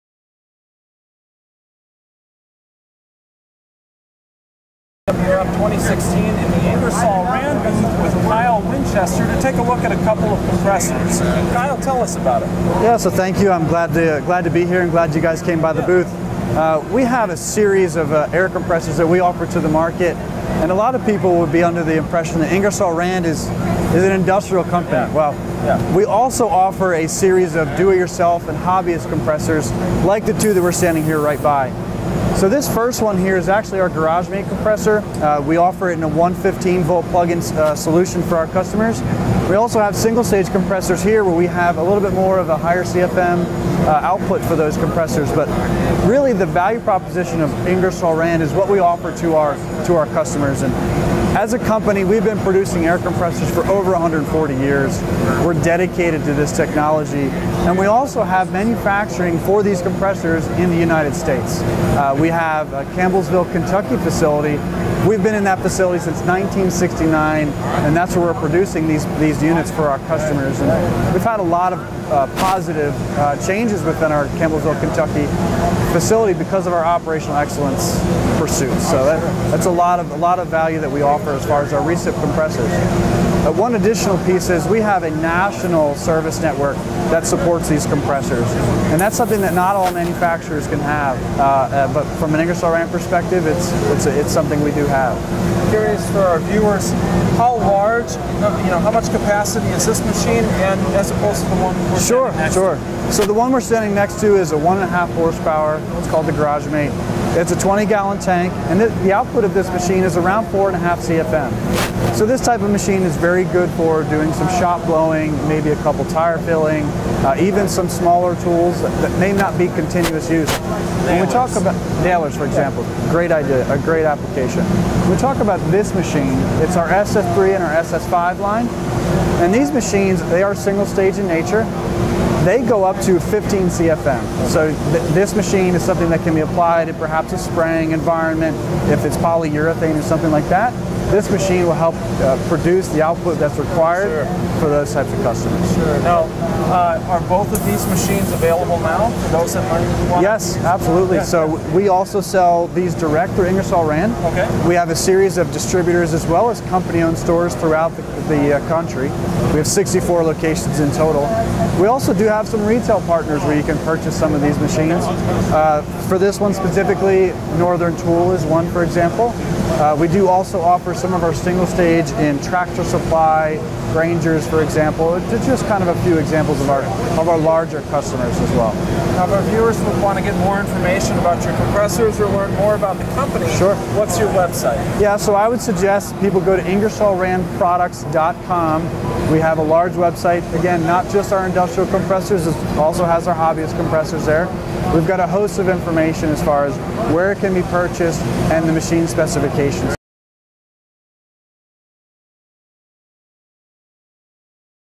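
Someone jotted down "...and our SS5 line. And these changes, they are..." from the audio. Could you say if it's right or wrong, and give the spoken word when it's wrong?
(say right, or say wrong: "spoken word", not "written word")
wrong: "machines", not "changes".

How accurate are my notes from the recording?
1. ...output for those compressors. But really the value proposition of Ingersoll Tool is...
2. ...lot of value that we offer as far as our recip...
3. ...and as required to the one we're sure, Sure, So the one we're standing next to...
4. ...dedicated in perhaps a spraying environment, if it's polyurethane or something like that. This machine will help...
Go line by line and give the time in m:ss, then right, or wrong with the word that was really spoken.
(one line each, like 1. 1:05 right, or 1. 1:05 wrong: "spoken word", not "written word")
1. 0:43 wrong: "Rand", not "Tool"
2. 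1:20 right
3. 1:40 wrong: "opposed", not "required"
4. 2:16 wrong: "applied", not "dedicated".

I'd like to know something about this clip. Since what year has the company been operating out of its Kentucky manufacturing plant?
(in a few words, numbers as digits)
1969.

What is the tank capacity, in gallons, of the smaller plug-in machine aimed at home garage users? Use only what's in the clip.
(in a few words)
20 gallons.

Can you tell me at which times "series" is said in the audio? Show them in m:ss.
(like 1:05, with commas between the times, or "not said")
0:17, 0:27, 2:34.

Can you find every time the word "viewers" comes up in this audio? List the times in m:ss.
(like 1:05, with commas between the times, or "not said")
1:36, 2:59.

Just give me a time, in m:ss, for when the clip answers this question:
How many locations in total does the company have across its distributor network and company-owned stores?
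2:39.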